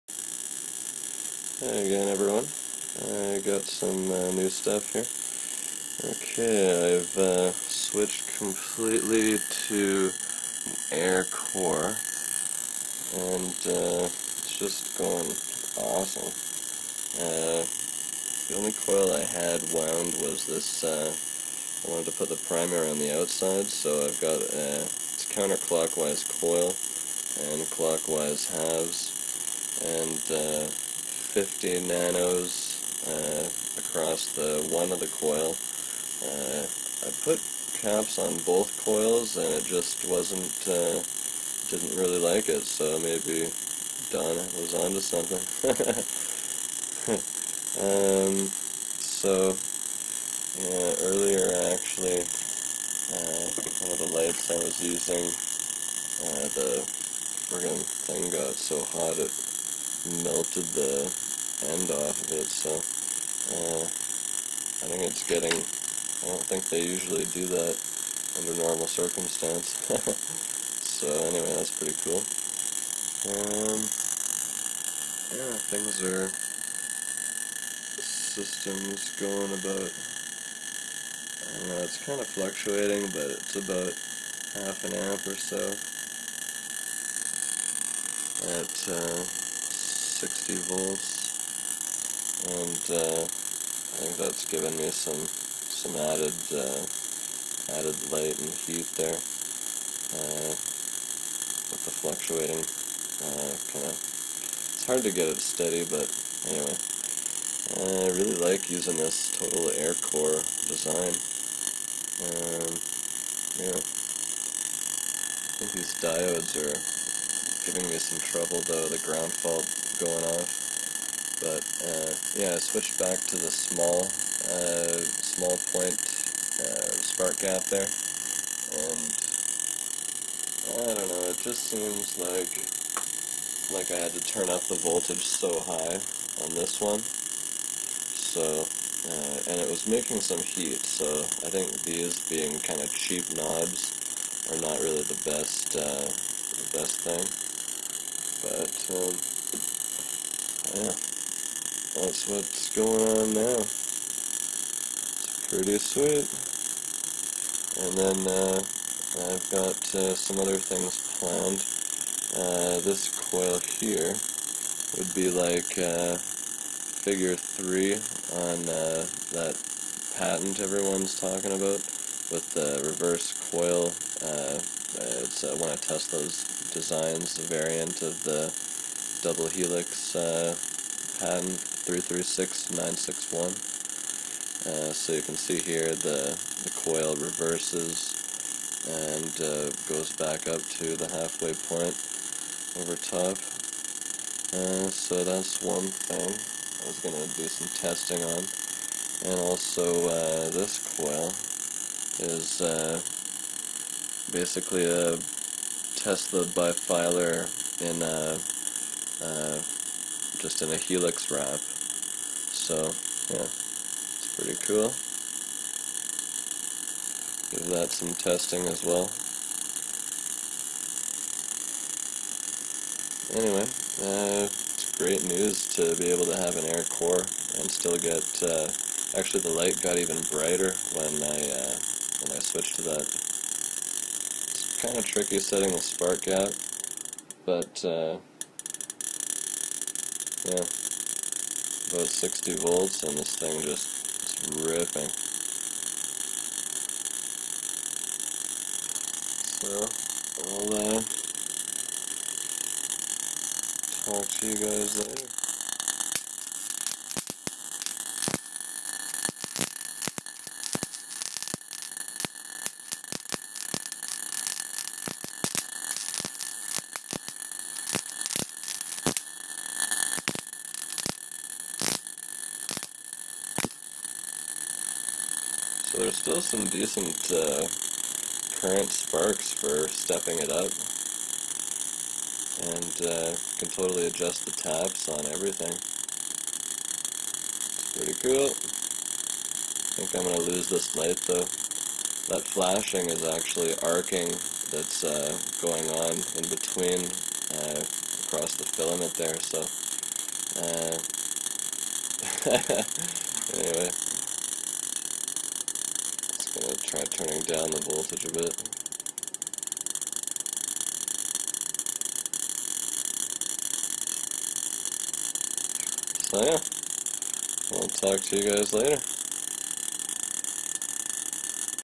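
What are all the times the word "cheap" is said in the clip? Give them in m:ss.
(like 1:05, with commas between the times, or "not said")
2:22.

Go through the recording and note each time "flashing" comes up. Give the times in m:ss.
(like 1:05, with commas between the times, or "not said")
4:52.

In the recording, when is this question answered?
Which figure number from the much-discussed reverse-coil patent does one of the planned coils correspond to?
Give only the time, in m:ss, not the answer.
2:46.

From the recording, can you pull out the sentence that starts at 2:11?
It just seems like like I had to turn up the voltage so high on this one.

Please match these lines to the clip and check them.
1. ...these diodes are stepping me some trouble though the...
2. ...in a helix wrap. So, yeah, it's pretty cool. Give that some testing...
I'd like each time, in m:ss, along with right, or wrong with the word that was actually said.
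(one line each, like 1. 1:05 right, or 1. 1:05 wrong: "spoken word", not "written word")
1. 1:55 wrong: "giving", not "stepping"
2. 3:30 right.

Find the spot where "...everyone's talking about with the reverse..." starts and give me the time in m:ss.
2:50.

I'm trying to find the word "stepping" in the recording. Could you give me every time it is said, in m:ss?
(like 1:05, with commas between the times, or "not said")
4:39.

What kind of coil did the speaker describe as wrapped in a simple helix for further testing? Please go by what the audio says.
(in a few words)
Tesla bifilar.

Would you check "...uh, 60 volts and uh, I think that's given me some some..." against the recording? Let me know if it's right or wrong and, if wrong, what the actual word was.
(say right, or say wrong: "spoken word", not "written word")
right.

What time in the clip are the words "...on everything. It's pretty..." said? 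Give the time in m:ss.
4:45.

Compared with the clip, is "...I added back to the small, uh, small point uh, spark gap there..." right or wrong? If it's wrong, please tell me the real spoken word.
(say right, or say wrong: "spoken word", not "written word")
wrong: "switched", not "added".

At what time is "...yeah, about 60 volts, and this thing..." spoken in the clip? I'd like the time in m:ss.
4:00.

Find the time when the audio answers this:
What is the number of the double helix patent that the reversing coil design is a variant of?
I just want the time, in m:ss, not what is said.
3:01.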